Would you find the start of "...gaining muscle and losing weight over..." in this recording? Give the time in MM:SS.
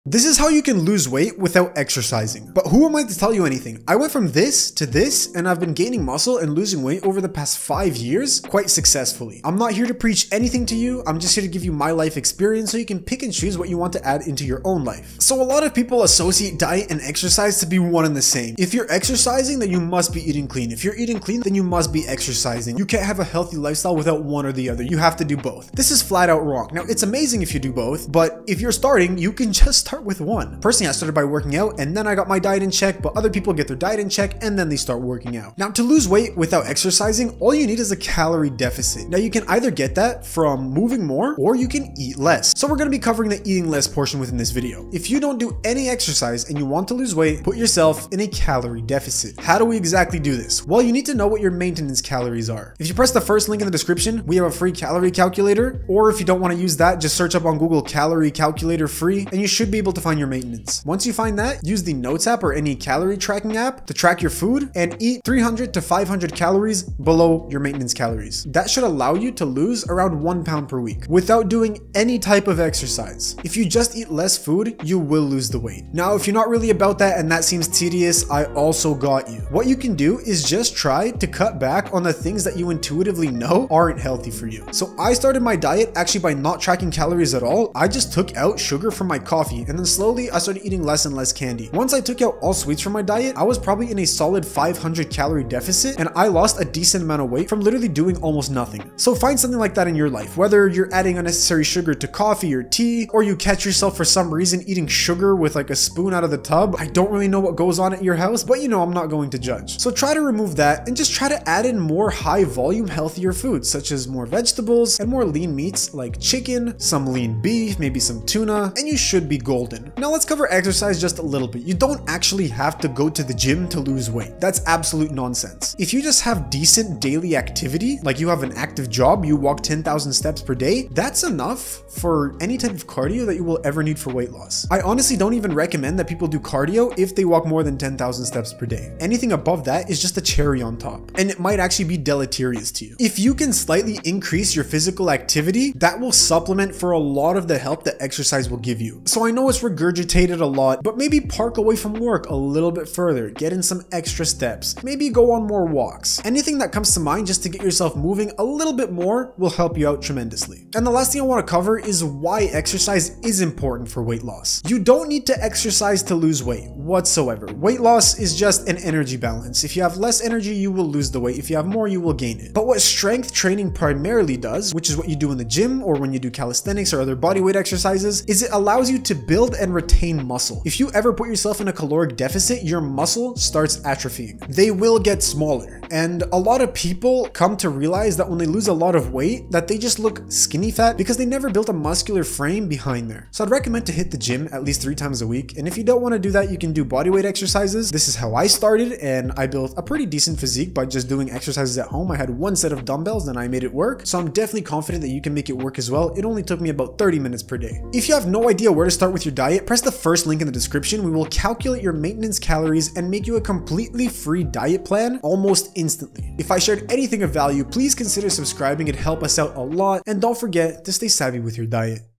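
00:05.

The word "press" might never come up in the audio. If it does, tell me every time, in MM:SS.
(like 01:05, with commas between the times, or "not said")
00:52, 03:29.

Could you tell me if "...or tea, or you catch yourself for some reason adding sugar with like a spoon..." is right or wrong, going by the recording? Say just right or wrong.
wrong.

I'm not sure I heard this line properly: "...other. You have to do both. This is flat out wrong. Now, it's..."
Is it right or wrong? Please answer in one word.
right.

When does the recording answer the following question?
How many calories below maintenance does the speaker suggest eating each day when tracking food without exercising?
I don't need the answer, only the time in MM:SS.
01:05.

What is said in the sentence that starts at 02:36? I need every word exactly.
Anything that comes to mind just to get yourself moving a little bit more will help you out tremendously.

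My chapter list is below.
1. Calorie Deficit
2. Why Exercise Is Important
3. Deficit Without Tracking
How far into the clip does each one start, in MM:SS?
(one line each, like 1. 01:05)
1. 00:35
2. 02:41
3. 01:16.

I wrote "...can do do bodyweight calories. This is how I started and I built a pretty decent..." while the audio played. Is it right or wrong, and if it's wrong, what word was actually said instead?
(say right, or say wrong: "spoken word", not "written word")
wrong: "exercises", not "calories".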